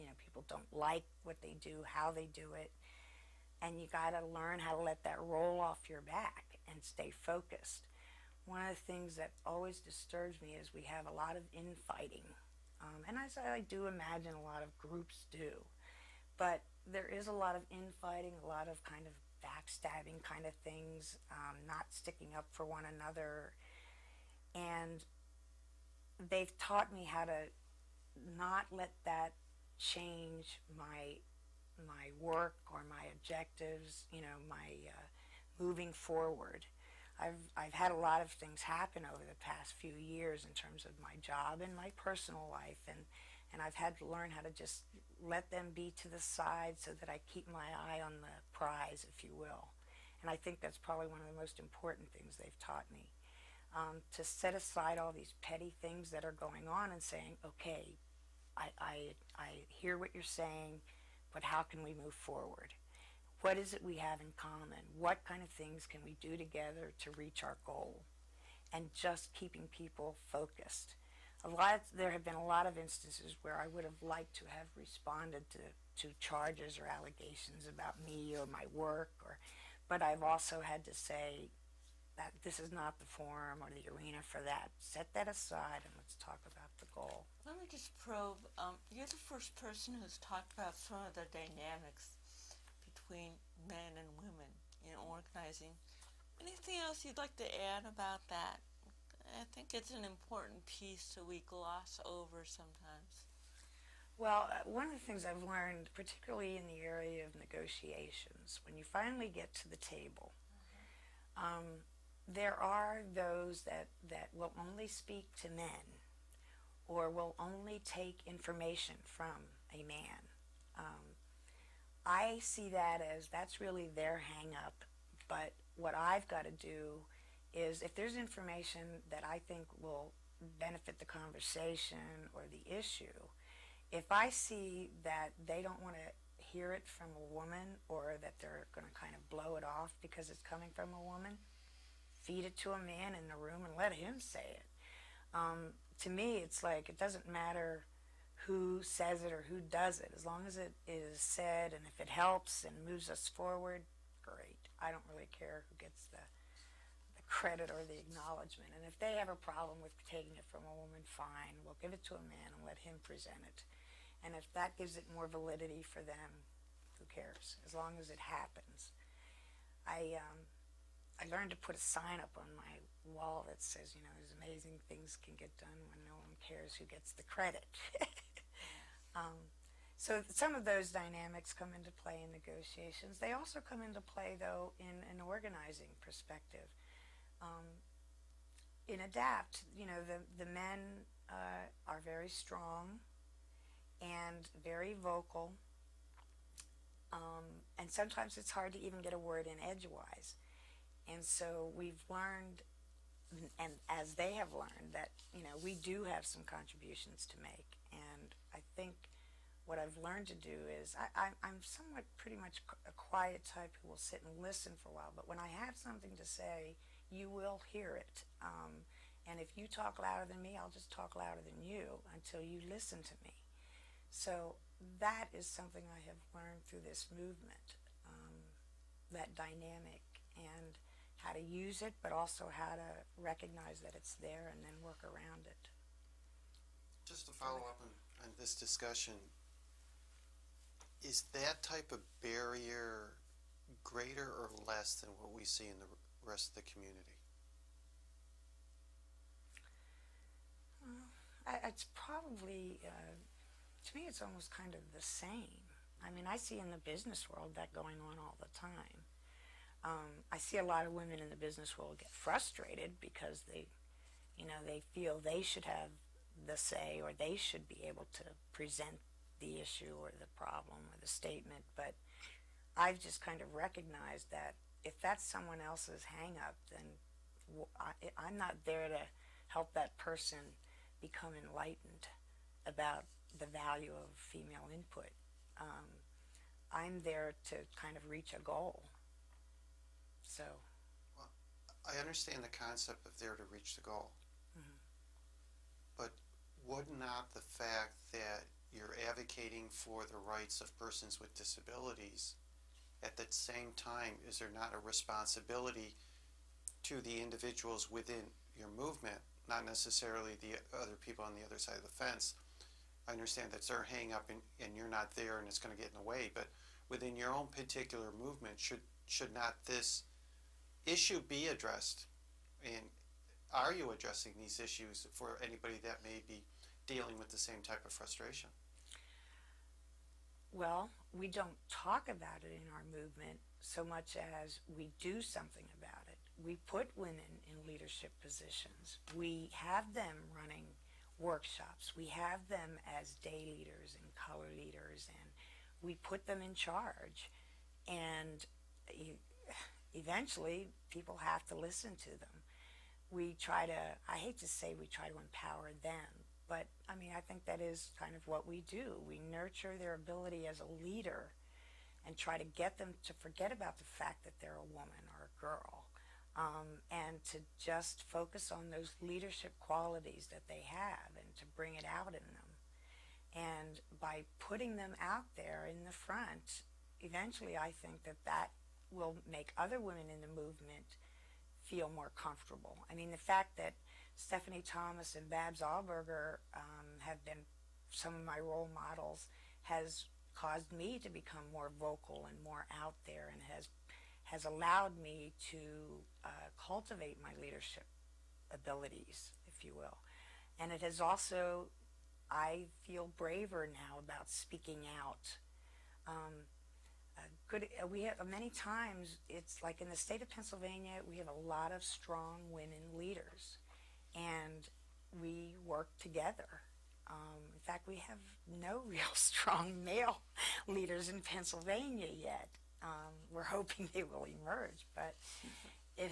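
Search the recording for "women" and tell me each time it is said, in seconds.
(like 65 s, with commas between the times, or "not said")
94 s, 260 s, 336 s, 379 s, 412 s.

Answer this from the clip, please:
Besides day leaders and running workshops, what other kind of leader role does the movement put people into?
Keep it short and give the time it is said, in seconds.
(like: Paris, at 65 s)
color leaders, at 344 s.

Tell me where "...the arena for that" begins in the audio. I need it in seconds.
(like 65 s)
83 s.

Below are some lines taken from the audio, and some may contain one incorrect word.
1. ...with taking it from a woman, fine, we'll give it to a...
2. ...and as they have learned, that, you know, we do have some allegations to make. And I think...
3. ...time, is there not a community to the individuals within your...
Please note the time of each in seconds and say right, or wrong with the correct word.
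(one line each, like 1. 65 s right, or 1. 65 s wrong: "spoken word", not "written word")
1. 159 s right
2. 203 s wrong: "contributions", not "allegations"
3. 303 s wrong: "responsibility", not "community".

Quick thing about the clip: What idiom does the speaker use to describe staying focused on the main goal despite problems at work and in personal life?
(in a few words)
eye on the prize.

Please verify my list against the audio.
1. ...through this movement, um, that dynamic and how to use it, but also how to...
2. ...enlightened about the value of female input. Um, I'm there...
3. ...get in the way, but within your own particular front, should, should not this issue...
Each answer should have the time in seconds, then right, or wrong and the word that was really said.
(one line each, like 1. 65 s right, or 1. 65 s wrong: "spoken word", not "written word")
1. 226 s right
2. 281 s right
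3. 315 s wrong: "movement", not "front".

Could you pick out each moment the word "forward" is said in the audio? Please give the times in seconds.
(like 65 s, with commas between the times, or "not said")
35 s, 62 s, 153 s.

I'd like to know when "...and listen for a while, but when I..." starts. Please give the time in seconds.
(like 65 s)
214 s.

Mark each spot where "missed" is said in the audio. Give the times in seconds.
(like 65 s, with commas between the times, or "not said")
not said.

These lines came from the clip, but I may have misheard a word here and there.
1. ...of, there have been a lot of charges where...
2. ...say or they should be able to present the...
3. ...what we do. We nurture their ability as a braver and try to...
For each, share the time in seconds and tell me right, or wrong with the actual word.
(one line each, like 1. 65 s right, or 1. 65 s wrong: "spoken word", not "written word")
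1. 71 s wrong: "instances", not "charges"
2. 266 s right
3. 358 s wrong: "leader", not "braver".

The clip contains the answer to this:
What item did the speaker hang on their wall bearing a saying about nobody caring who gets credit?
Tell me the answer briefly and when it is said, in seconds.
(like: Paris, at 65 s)
a sign, at 171 s.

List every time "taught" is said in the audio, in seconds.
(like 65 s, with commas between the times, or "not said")
26 s, 52 s.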